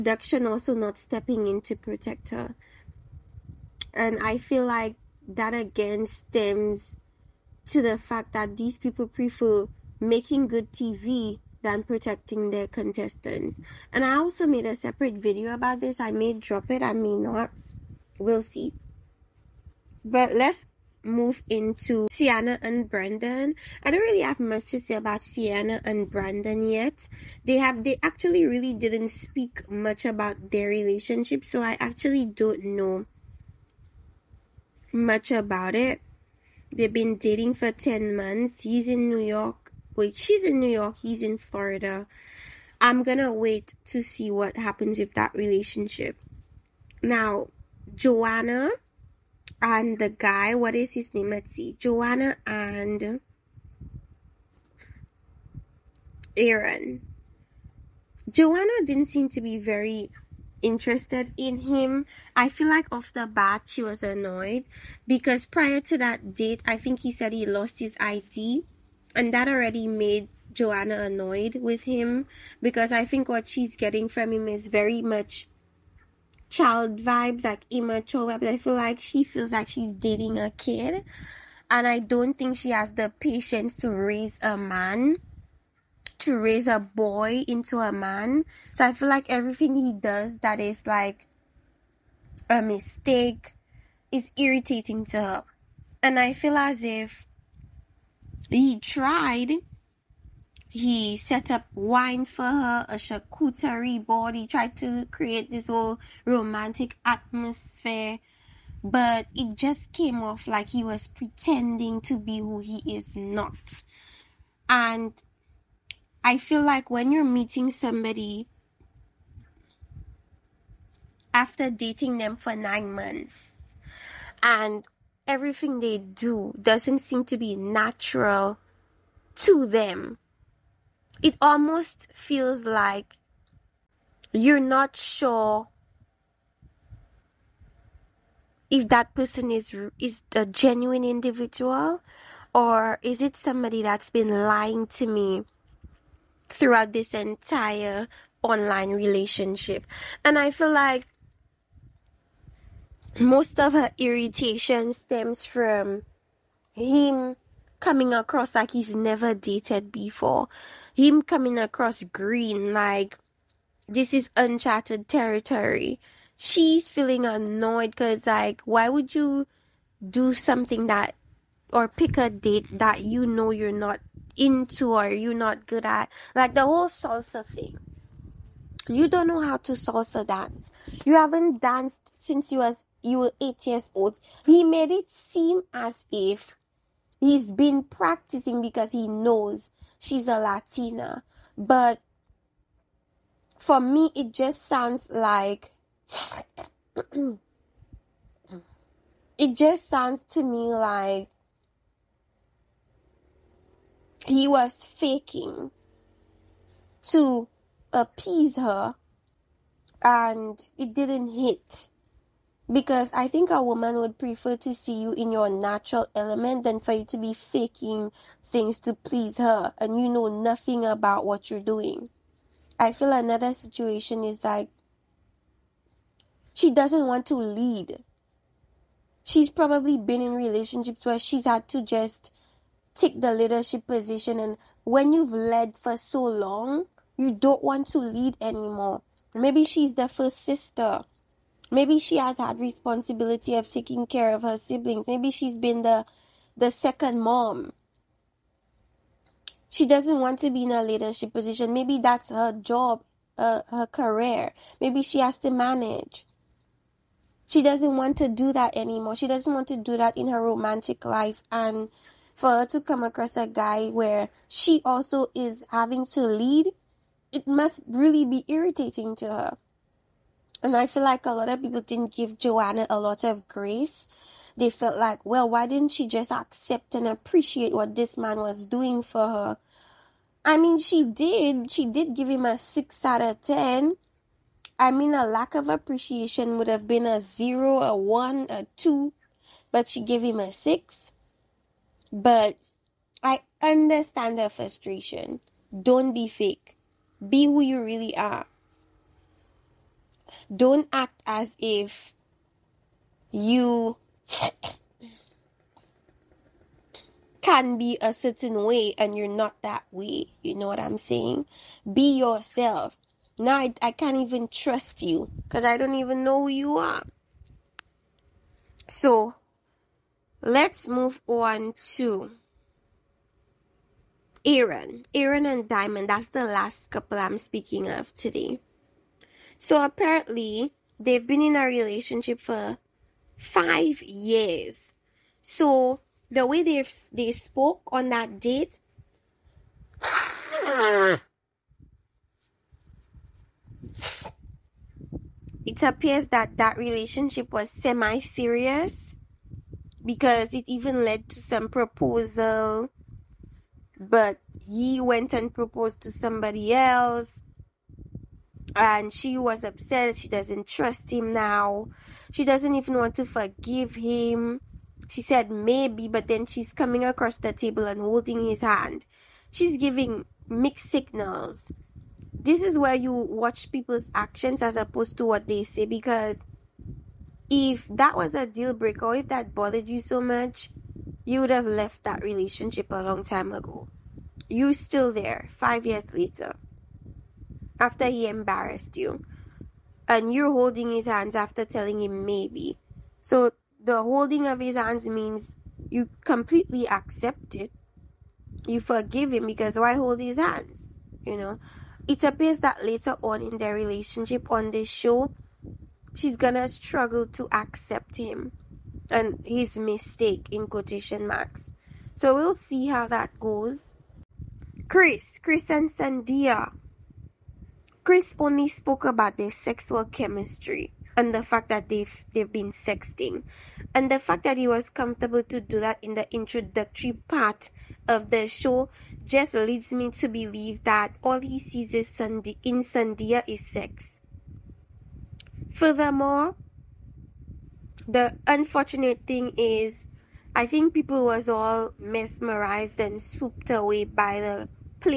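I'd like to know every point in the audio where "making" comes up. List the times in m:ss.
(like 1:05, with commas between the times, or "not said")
0:09.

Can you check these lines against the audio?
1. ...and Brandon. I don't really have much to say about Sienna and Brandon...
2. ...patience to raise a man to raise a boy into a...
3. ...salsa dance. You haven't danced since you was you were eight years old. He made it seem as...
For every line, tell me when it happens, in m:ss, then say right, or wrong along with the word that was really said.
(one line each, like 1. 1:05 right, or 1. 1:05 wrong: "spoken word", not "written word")
1. 0:22 right
2. 1:23 right
3. 2:59 right.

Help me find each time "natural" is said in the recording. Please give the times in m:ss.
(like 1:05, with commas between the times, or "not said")
2:07, 3:35.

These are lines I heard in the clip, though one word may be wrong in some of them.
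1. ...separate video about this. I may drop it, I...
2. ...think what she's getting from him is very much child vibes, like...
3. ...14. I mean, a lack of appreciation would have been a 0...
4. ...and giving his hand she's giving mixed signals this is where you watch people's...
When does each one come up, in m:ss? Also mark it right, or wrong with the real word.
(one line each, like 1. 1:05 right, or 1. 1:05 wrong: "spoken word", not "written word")
1. 0:14 right
2. 1:13 right
3. 4:43 wrong: "10", not "14"
4. 6:07 wrong: "holding", not "giving".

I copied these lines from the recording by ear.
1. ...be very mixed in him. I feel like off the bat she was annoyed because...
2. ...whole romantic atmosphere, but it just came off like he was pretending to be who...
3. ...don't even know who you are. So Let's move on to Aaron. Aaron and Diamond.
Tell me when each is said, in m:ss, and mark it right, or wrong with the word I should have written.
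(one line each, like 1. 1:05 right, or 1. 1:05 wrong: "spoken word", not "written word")
1. 0:59 wrong: "interested", not "mixed"
2. 1:45 right
3. 5:15 right.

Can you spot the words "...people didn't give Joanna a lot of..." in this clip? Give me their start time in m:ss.
4:31.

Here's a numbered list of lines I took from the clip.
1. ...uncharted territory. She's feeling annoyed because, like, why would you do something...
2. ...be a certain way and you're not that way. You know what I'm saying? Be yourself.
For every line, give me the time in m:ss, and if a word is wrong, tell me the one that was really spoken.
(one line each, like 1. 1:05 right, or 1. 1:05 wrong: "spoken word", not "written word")
1. 2:44 right
2. 5:07 right.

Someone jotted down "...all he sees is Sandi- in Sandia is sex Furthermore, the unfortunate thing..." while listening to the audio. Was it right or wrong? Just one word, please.
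right.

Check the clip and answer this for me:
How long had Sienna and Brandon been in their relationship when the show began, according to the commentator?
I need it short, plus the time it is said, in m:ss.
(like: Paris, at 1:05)
10 months, at 0:37.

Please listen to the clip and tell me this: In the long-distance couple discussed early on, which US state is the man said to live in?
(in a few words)
Florida.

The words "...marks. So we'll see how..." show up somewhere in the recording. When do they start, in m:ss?
6:51.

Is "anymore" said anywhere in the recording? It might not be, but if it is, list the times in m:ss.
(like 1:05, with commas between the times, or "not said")
3:58, 4:18.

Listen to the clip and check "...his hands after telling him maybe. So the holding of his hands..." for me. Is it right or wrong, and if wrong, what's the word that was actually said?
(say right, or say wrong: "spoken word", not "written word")
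right.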